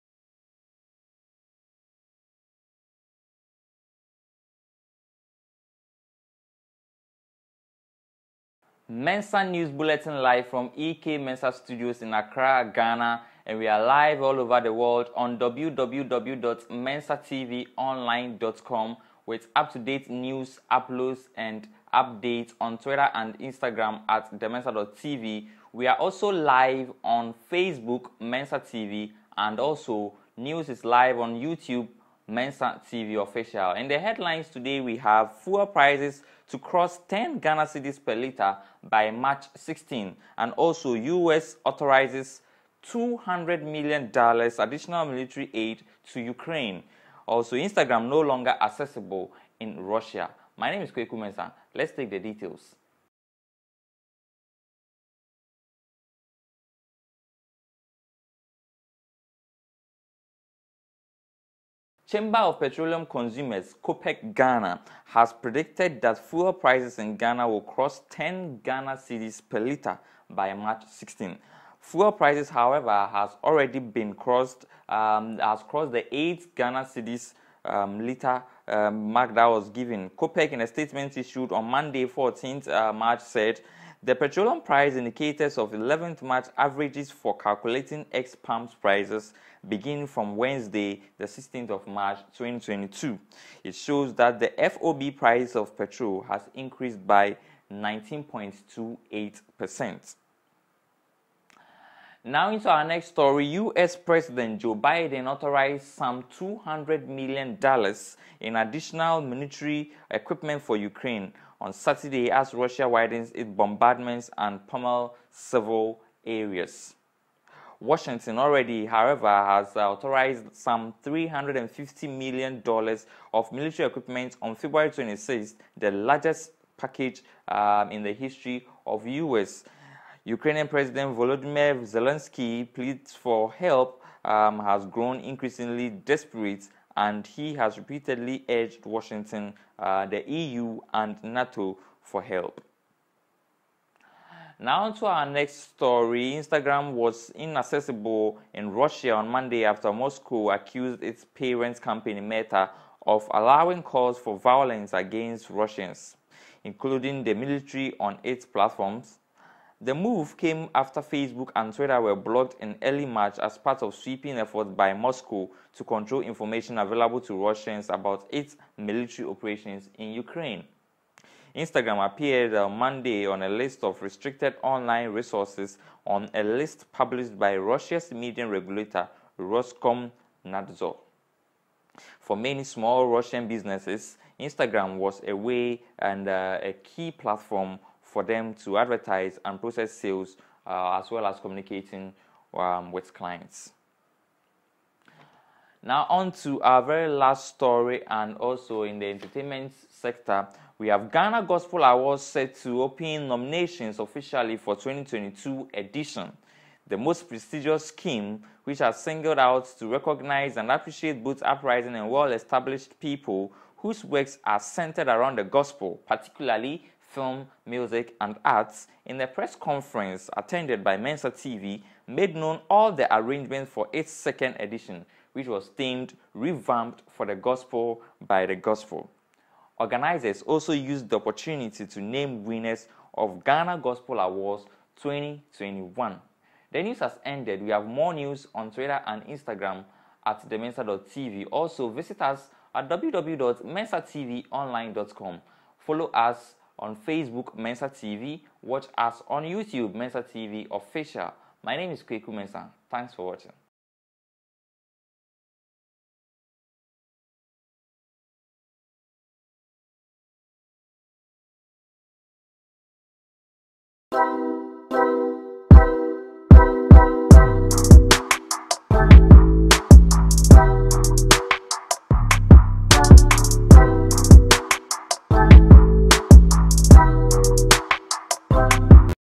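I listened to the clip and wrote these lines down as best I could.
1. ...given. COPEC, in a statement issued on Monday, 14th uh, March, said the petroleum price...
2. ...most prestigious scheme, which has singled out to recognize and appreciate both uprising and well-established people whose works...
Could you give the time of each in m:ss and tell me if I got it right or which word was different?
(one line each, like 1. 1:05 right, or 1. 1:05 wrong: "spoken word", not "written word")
1. 1:19 right
2. 3:26 right.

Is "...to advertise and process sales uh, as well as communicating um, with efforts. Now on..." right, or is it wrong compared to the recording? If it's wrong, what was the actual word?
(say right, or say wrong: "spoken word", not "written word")
wrong: "clients", not "efforts".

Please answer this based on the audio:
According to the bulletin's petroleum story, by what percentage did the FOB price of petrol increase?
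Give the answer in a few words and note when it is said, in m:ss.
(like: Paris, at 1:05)
19.28%, at 1:37.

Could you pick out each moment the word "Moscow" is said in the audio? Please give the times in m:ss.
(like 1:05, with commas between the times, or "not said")
2:29, 2:44.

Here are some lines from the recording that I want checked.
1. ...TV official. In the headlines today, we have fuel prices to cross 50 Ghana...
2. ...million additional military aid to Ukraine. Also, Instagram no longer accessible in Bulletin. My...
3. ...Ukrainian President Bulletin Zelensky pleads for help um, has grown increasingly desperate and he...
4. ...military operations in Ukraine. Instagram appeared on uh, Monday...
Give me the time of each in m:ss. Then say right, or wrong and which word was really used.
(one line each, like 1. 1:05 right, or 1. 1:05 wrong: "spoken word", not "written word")
1. 0:32 wrong: "10", not "50"
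2. 0:43 wrong: "Russia", not "Bulletin"
3. 2:10 wrong: "Volodymyr", not "Bulletin"
4. 2:48 right.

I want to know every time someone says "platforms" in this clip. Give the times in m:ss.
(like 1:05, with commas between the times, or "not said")
2:38, 3:07.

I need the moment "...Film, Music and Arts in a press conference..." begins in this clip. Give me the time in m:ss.
3:37.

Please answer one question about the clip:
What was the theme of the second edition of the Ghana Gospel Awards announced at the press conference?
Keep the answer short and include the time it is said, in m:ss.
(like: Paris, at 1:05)
Revamped for the Gospel by the Gospel, at 3:46.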